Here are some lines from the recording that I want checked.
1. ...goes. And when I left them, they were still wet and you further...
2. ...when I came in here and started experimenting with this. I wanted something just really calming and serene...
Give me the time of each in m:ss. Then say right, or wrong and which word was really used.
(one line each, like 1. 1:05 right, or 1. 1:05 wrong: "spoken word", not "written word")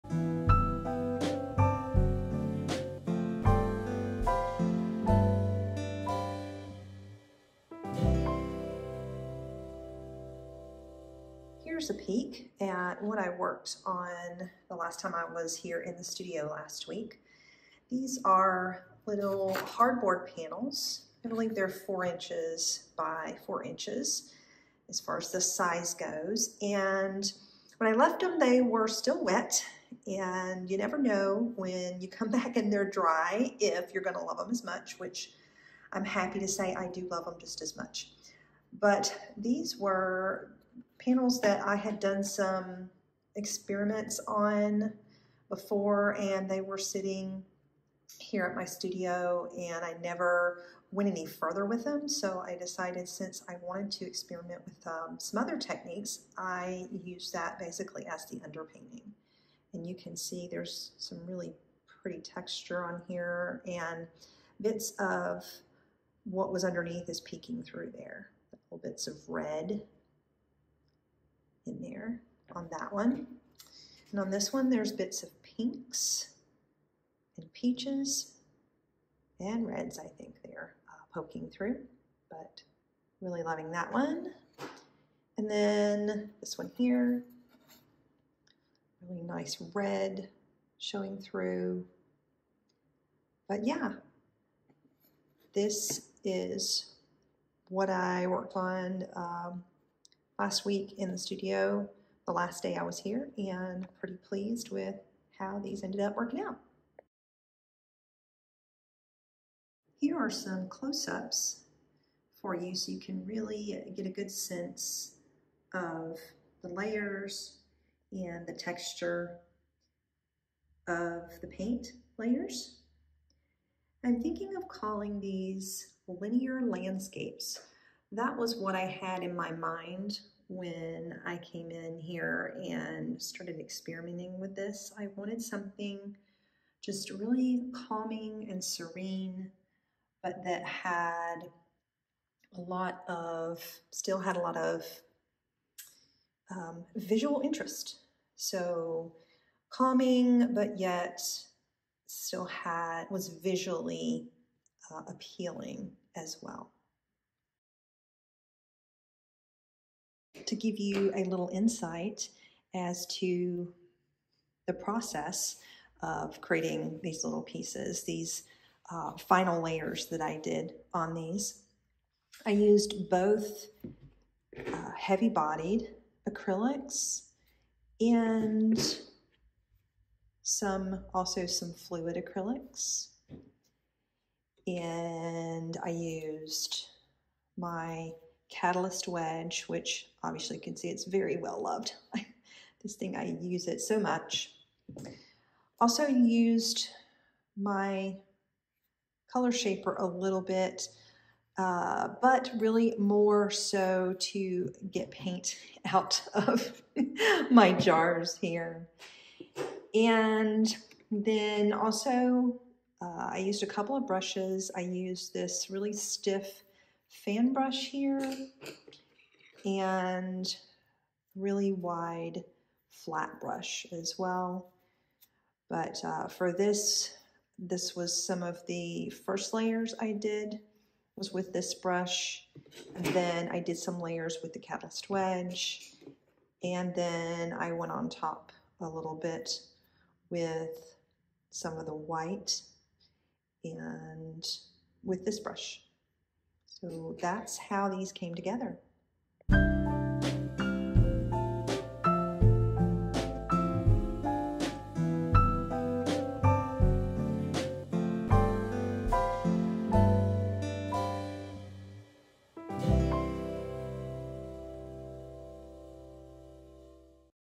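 1. 0:25 wrong: "never", not "further"
2. 2:10 right.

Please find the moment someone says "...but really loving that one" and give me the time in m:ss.
1:22.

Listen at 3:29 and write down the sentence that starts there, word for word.
And then also uh, I used a couple of brushes.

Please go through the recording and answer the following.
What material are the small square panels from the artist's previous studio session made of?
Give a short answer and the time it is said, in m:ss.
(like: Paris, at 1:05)
hardboard, at 0:19.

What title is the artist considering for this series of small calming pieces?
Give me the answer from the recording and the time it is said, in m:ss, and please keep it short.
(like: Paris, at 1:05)
linear landscapes, at 2:06.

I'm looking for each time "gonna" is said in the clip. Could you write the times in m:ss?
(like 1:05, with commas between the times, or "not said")
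0:34.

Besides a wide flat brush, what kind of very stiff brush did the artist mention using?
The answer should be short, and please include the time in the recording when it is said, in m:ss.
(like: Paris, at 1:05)
fan brush, at 3:37.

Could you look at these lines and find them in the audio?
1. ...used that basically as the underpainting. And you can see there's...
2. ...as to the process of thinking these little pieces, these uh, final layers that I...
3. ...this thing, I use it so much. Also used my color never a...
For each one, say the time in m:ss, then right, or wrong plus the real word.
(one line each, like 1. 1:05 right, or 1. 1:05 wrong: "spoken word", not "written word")
1. 0:57 right
2. 2:42 wrong: "creating", not "thinking"
3. 3:12 wrong: "shaper", not "never".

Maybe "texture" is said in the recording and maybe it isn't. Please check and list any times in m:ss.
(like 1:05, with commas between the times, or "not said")
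1:02, 1:58.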